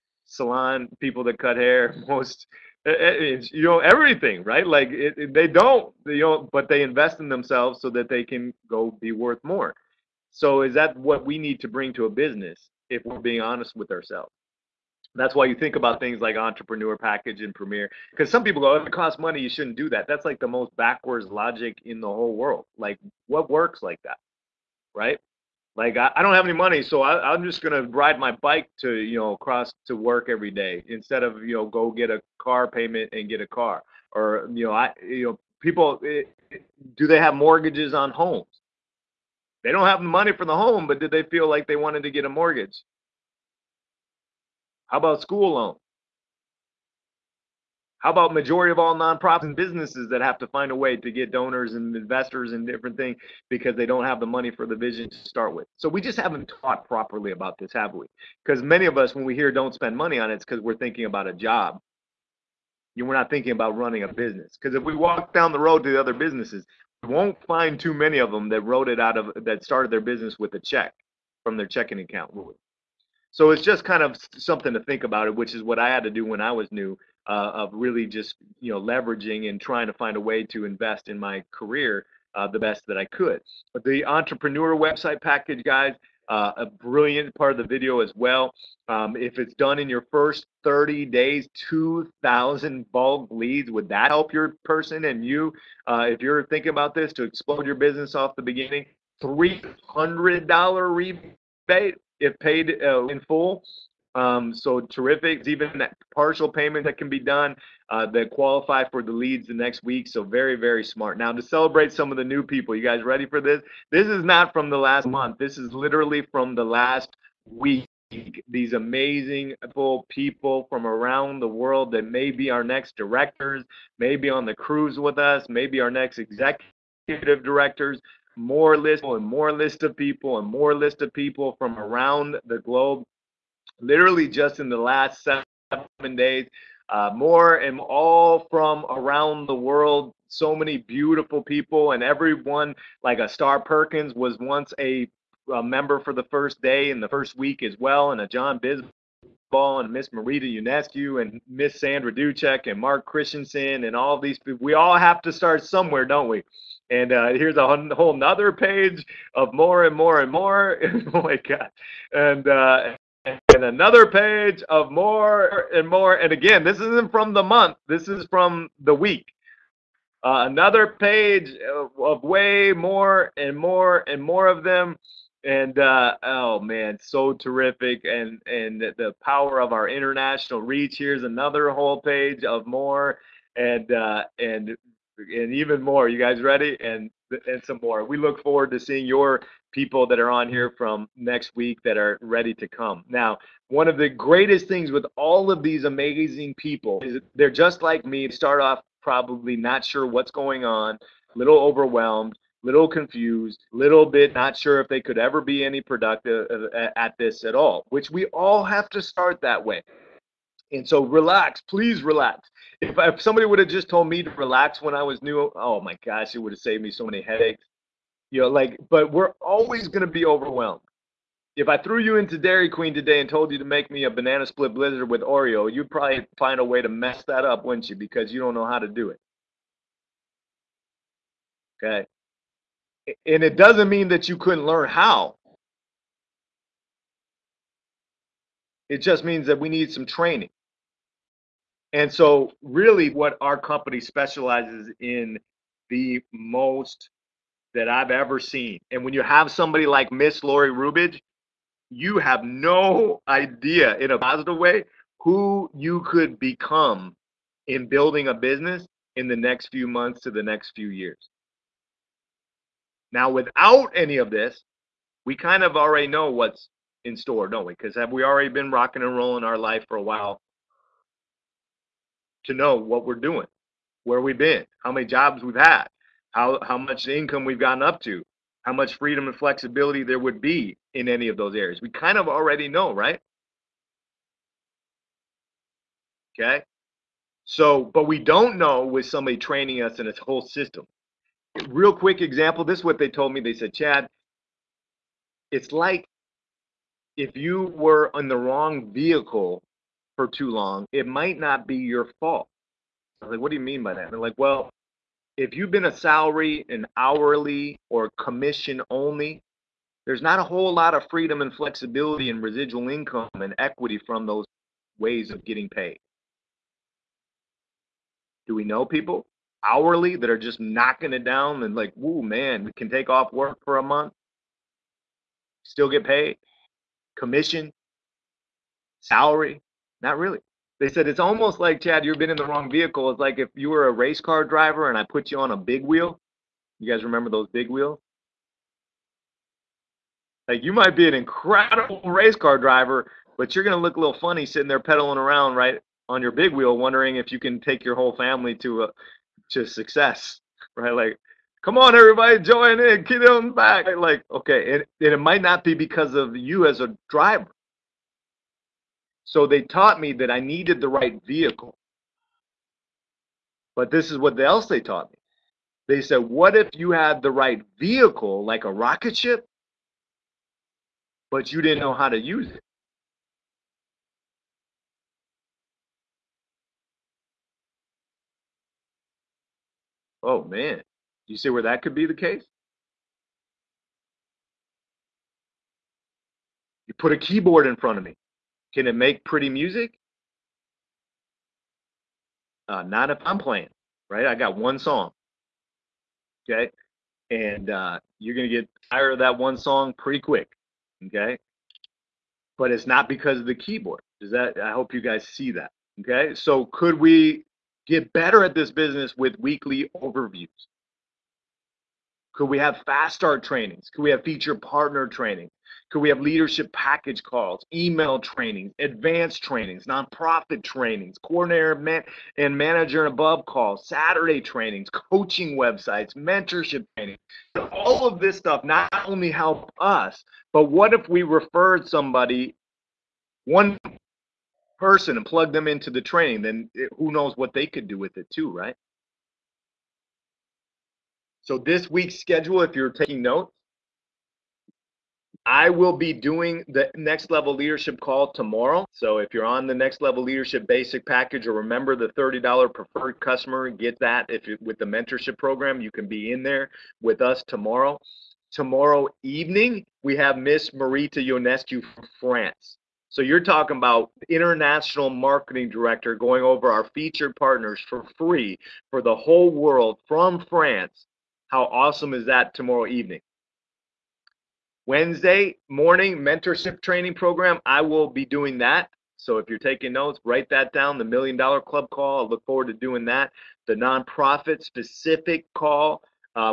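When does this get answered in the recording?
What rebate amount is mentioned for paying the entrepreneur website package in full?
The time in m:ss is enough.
1:39.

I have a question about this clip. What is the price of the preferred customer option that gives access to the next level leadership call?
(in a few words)
$30.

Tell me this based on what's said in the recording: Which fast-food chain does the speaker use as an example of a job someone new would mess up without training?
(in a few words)
Dairy Queen.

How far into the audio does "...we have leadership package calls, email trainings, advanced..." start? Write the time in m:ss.
6:55.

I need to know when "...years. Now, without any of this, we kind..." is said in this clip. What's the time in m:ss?
4:20.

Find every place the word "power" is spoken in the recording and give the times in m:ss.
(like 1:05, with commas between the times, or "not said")
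2:59.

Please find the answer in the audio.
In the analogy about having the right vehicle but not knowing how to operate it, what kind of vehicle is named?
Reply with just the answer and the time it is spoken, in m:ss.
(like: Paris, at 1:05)
Rocket ship, at 6:08.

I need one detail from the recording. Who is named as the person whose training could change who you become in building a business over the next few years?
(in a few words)
Lori Rubidge.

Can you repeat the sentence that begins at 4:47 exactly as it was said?
So, but we don't know with somebody training us in a whole system.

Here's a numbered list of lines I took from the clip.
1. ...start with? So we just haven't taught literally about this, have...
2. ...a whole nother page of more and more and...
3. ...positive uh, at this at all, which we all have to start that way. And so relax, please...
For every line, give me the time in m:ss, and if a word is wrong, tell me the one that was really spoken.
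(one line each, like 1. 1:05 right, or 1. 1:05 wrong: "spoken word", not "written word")
1. 0:55 wrong: "properly", not "literally"
2. 2:37 right
3. 3:25 wrong: "productive", not "positive".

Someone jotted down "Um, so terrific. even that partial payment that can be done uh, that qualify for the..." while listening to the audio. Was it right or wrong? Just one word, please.
right.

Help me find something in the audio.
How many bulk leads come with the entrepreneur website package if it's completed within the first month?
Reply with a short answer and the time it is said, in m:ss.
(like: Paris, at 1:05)
2,000, at 1:31.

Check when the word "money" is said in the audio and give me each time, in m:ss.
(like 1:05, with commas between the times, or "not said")
0:19, 0:26, 0:40, 0:54, 0:59.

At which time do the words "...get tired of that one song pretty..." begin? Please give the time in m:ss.
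6:38.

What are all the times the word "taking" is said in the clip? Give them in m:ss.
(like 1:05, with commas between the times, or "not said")
7:22, 7:59.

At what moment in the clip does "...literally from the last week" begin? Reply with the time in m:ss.
1:55.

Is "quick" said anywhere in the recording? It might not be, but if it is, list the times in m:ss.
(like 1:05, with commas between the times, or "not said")
4:51, 6:40.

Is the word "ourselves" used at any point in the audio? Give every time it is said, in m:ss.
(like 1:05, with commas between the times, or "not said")
0:13.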